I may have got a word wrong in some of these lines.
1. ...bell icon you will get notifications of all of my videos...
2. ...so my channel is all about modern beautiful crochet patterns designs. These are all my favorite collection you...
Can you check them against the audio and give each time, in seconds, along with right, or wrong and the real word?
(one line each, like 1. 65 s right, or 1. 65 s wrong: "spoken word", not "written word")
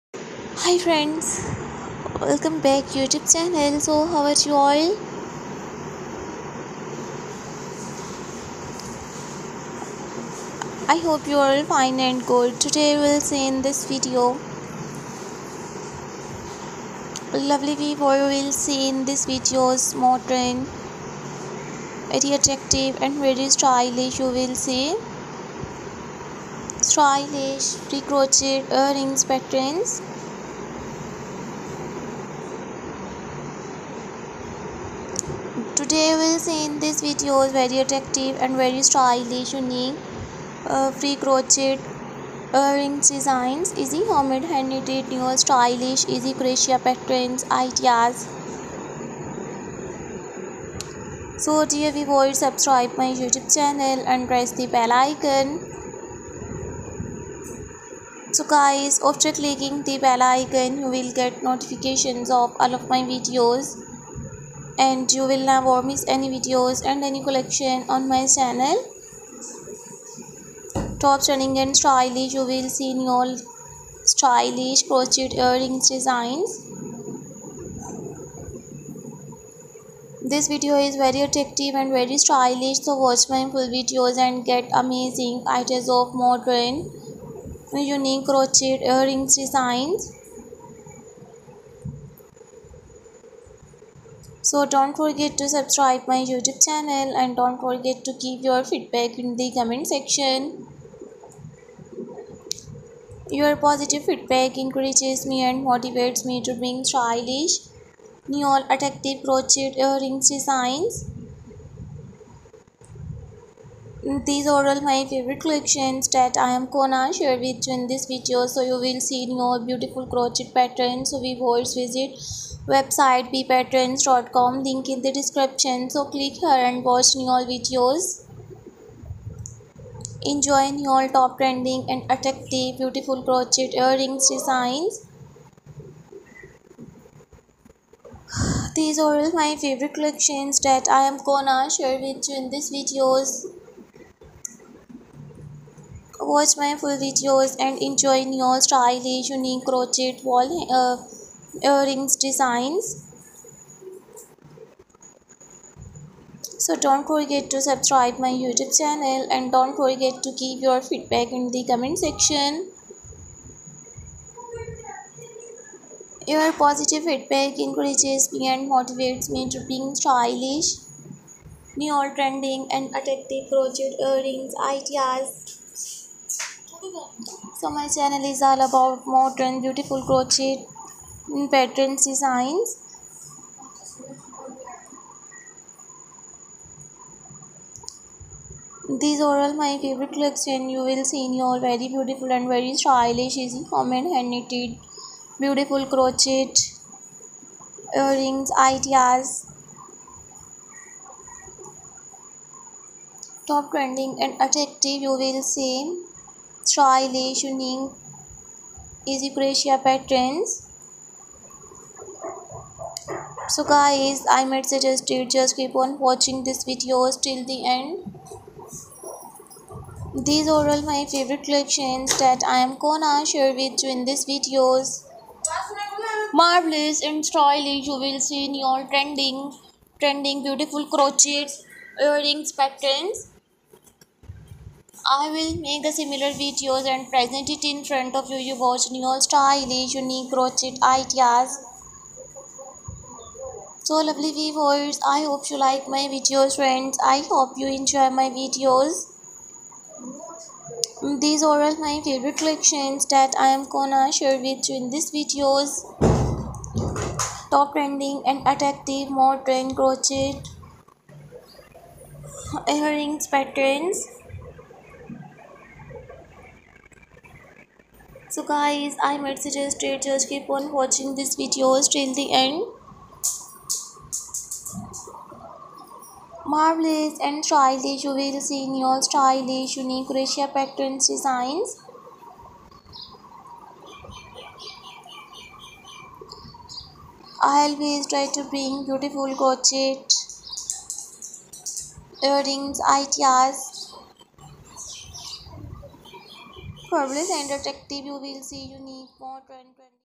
1. 59 s right
2. 177 s right.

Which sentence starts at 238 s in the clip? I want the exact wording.
You watch new stylish, unique crochet ideas.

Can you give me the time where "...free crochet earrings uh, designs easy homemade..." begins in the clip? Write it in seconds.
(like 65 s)
41 s.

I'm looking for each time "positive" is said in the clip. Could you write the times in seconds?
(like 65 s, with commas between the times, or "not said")
103 s, 166 s.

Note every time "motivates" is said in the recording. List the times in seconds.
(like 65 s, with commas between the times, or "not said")
105 s, 168 s.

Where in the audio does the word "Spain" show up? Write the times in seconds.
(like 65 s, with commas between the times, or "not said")
not said.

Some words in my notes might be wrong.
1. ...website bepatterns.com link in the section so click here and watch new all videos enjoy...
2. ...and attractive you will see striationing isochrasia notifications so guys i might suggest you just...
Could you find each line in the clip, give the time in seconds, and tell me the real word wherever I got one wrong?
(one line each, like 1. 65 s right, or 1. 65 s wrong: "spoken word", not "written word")
1. 122 s wrong: "description", not "section"
2. 204 s wrong: "patterns", not "notifications".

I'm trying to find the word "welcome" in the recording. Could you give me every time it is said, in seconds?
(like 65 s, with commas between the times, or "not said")
2 s.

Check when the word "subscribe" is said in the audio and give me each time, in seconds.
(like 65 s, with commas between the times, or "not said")
52 s, 95 s, 157 s.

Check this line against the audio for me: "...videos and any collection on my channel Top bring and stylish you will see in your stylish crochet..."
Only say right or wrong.
wrong.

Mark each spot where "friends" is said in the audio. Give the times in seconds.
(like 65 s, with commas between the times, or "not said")
0 s, 246 s.